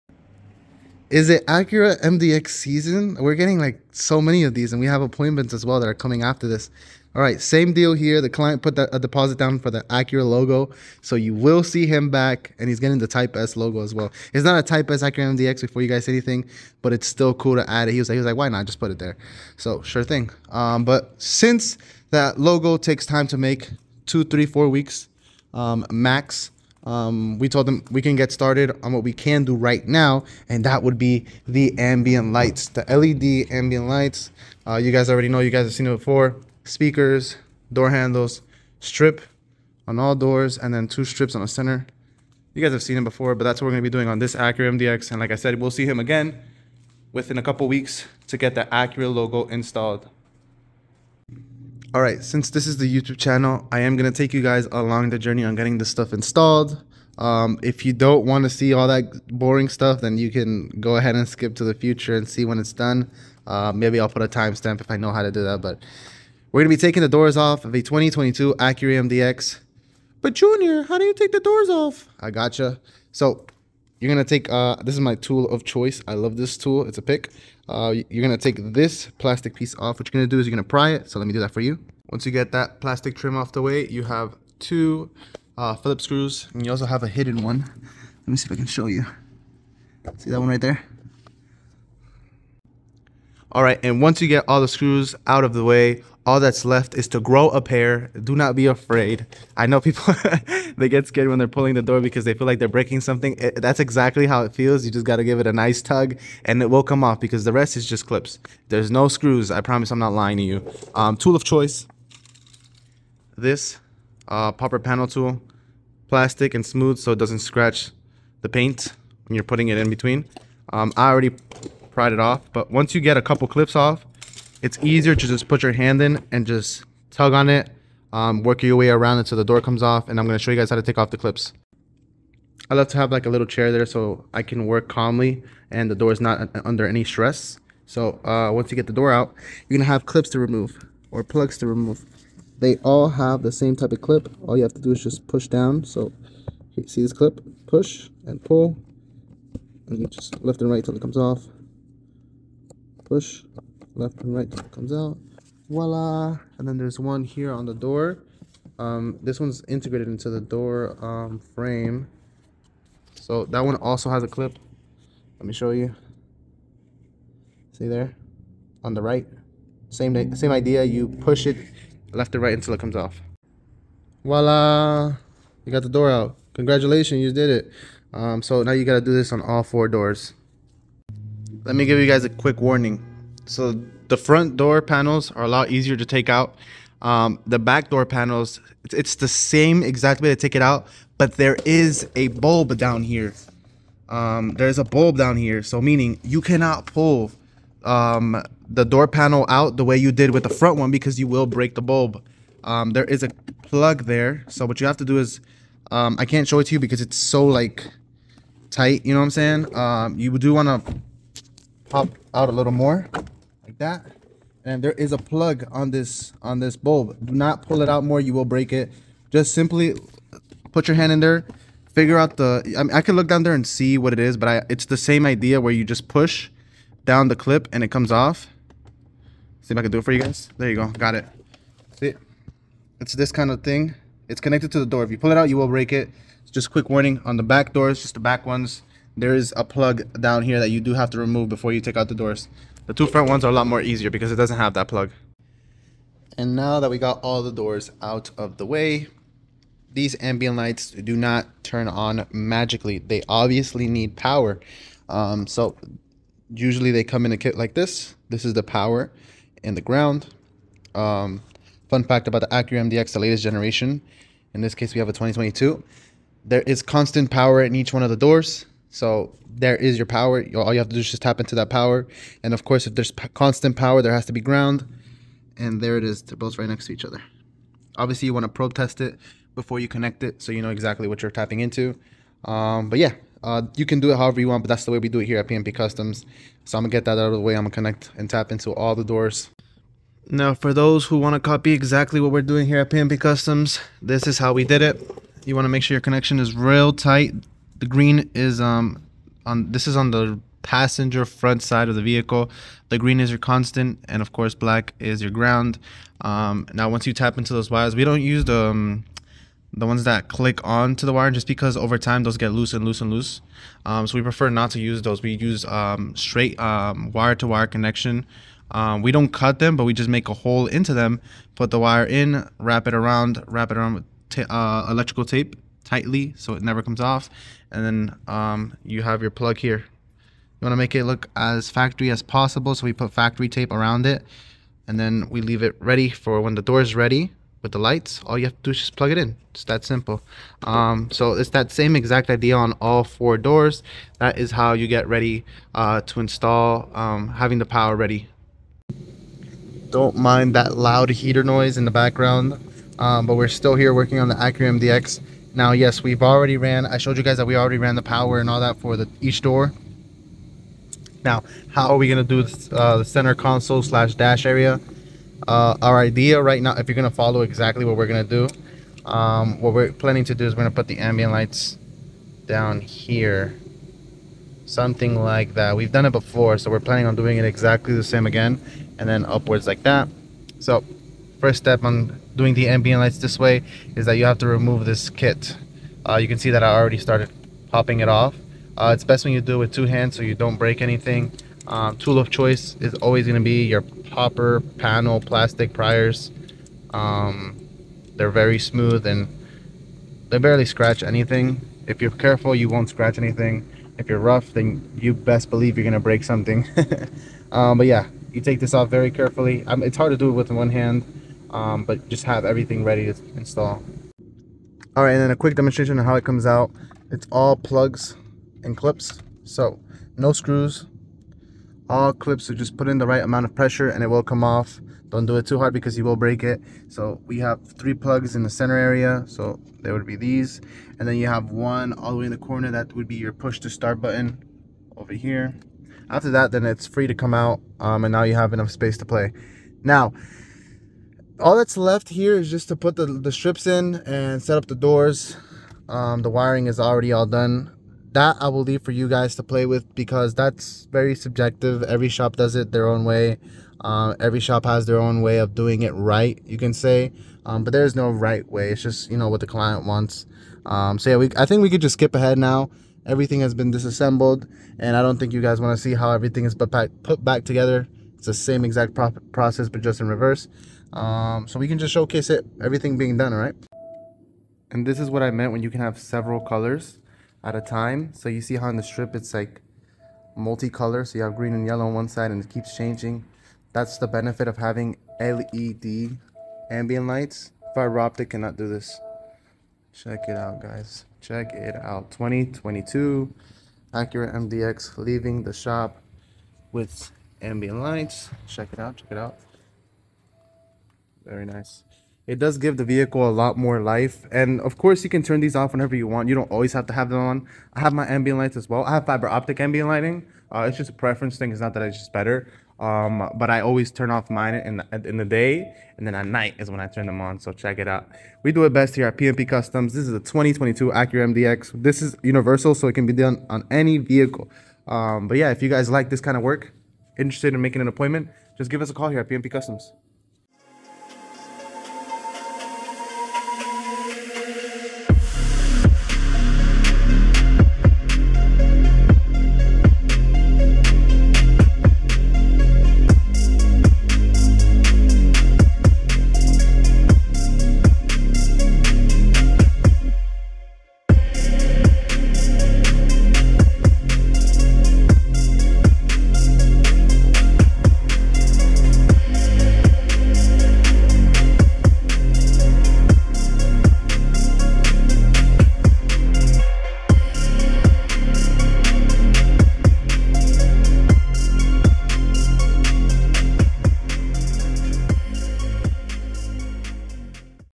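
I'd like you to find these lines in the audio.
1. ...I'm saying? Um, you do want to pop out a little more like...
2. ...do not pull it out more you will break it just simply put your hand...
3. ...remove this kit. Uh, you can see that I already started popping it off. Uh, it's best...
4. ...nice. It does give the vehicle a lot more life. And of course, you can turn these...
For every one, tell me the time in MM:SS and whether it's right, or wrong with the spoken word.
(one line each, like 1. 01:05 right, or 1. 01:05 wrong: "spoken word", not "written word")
1. 03:29 right
2. 03:37 right
3. 06:24 right
4. 08:21 right.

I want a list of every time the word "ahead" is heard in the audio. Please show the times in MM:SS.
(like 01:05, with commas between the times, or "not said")
01:00, 07:42.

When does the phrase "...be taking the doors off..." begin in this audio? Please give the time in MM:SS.
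01:06.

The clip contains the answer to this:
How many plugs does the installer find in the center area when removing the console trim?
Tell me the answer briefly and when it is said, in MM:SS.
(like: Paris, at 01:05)
3, at 07:07.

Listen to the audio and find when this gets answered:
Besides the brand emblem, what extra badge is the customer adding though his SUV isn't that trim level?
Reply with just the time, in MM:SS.
00:13.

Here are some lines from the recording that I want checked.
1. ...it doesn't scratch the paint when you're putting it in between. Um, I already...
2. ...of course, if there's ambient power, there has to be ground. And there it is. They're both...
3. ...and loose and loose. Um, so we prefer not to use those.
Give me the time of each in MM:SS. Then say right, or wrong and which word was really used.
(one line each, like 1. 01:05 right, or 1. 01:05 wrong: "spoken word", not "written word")
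1. 01:57 right
2. 04:32 wrong: "constant", not "ambient"
3. 05:12 right.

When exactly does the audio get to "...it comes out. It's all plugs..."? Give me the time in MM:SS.
06:56.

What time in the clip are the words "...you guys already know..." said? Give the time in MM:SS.
00:34.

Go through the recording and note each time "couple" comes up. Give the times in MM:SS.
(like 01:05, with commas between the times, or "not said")
00:47, 02:03.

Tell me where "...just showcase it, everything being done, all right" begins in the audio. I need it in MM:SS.
07:51.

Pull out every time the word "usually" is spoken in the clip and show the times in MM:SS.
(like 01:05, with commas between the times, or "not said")
04:16.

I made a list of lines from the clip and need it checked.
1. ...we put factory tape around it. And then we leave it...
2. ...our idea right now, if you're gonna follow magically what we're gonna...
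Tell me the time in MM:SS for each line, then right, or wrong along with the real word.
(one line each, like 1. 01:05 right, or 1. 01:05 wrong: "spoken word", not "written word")
1. 05:32 right
2. 06:05 wrong: "exactly", not "magically".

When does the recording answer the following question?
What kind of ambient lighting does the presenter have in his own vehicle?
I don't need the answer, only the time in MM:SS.
08:29.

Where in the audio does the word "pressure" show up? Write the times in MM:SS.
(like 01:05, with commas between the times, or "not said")
07:03.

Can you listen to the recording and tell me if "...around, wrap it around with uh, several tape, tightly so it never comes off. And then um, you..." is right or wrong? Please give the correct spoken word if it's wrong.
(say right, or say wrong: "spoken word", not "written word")
wrong: "electrical", not "several".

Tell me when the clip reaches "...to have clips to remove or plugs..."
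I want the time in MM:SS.
02:19.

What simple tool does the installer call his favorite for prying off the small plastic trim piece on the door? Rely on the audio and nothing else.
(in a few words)
A pick.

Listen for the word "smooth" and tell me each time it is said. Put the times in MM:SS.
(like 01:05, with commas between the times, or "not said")
01:56, 06:38.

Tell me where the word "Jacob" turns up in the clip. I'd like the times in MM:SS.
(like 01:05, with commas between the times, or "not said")
not said.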